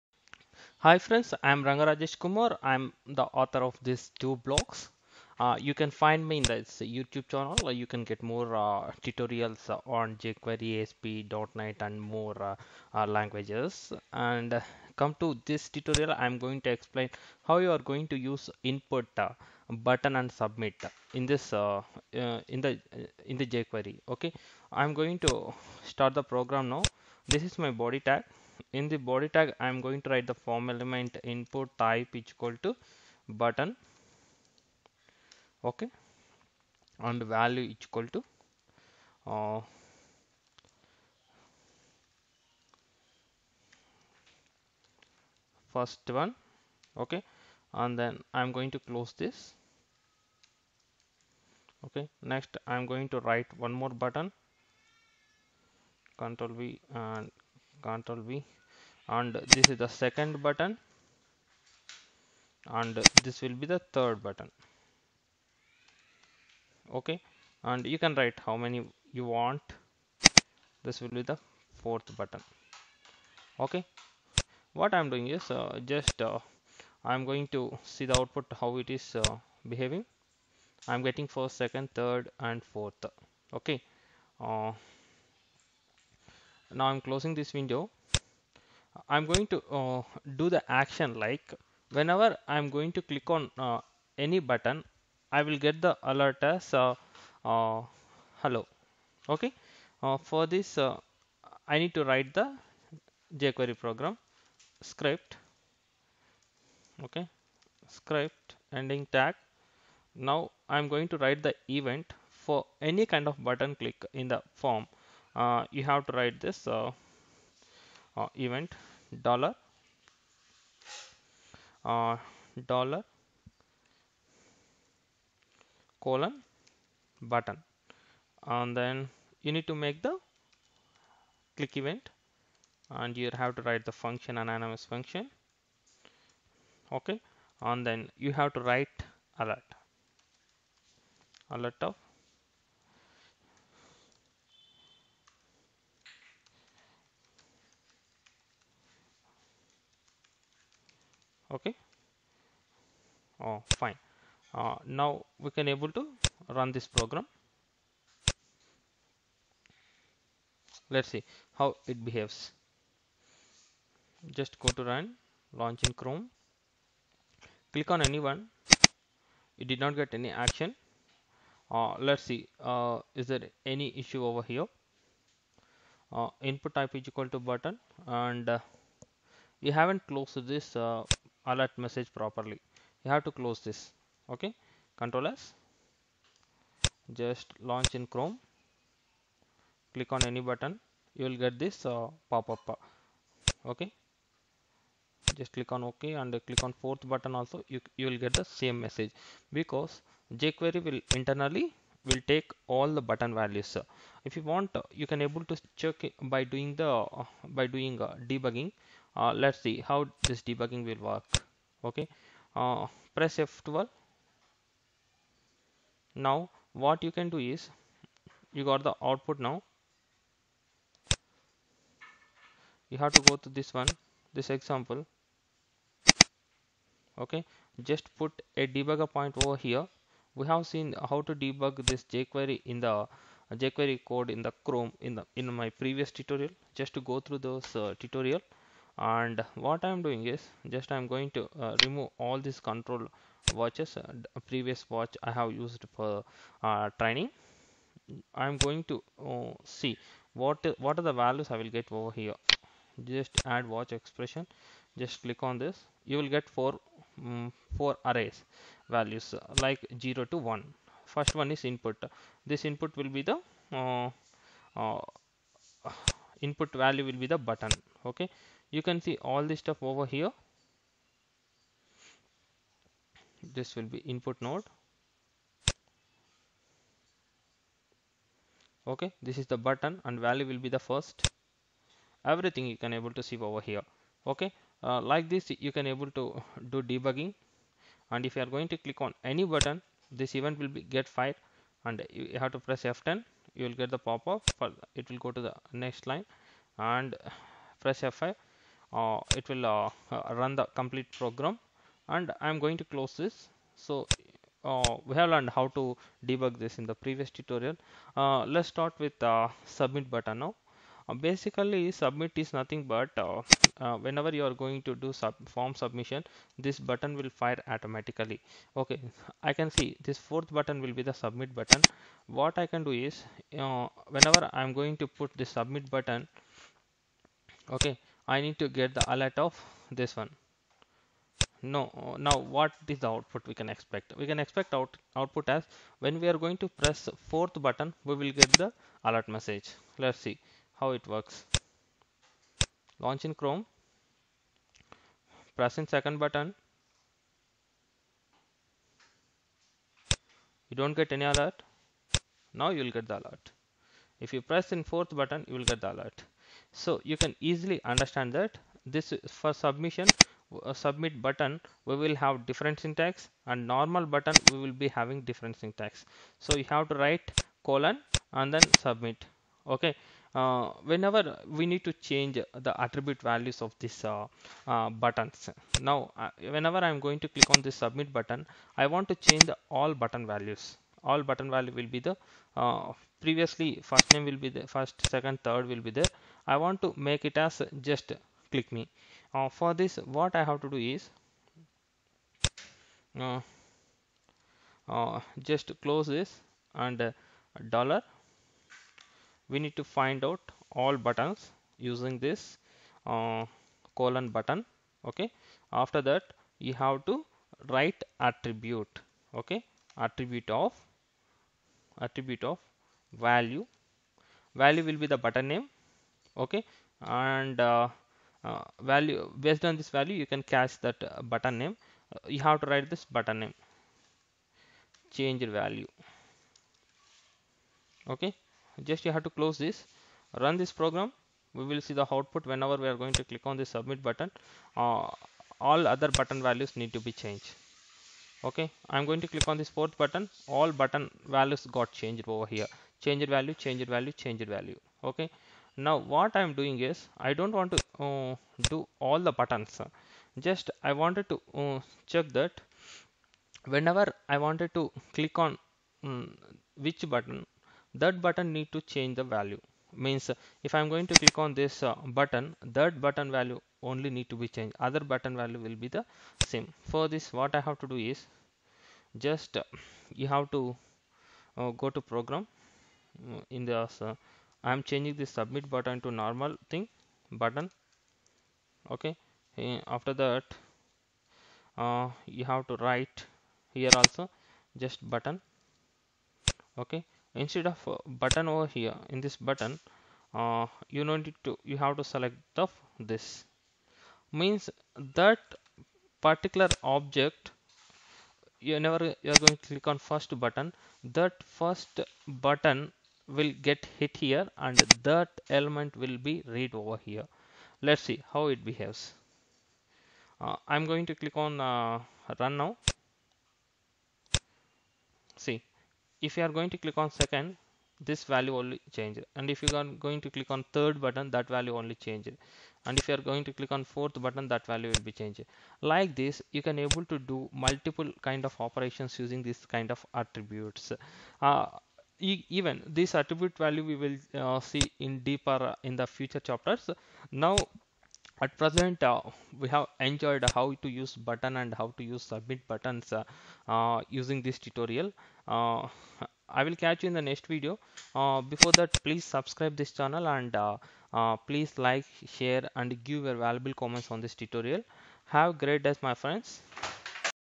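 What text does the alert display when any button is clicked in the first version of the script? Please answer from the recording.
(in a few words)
hello.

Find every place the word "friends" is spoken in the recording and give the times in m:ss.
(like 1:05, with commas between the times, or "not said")
0:00, 9:16.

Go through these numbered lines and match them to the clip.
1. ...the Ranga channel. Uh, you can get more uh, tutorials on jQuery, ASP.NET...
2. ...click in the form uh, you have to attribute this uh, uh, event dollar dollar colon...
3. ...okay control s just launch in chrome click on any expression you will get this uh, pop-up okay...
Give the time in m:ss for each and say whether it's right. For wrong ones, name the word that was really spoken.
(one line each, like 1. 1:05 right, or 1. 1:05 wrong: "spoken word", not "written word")
1. 0:06 wrong: "YouTube", not "Ranga"
2. 1:53 wrong: "write", not "attribute"
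3. 3:04 wrong: "button", not "expression".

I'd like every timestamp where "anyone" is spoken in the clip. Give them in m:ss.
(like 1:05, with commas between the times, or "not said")
2:48.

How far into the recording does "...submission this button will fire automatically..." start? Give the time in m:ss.
5:15.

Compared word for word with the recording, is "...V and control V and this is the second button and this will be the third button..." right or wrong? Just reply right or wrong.
right.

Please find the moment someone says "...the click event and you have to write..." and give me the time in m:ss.
2:10.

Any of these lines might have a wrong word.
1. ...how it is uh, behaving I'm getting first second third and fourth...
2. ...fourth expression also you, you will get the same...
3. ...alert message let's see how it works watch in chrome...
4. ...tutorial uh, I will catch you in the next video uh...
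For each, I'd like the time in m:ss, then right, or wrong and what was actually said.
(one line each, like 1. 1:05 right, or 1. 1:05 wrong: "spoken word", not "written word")
1. 1:18 right
2. 3:16 wrong: "button", not "expression"
3. 5:39 wrong: "launch", not "watch"
4. 9:04 right.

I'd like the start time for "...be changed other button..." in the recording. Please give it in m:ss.
7:44.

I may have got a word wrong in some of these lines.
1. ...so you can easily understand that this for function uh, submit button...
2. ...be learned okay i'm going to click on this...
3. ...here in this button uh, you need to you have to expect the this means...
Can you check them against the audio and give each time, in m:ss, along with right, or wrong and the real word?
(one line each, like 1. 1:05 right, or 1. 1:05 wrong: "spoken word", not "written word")
1. 5:56 wrong: "submission", not "function"
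2. 7:17 wrong: "changed", not "learned"
3. 8:08 wrong: "select", not "expect".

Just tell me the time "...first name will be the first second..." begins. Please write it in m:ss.
6:23.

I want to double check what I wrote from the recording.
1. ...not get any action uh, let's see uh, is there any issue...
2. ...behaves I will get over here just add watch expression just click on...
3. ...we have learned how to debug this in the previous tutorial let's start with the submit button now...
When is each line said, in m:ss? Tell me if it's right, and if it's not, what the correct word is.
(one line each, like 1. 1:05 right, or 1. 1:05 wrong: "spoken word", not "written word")
1. 2:49 right
2. 4:11 wrong: "values", not "behaves"
3. 5:05 right.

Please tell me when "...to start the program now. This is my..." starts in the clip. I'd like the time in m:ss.
0:25.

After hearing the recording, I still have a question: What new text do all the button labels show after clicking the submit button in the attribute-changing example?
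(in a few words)
change value.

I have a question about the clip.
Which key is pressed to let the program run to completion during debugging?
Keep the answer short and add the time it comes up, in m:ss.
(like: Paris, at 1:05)
F5, at 4:57.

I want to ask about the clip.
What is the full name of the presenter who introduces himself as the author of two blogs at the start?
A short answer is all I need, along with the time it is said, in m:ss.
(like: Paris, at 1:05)
Ranga Rajesh Kumar, at 0:01.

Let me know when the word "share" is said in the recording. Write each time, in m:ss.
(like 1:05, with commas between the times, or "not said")
9:12.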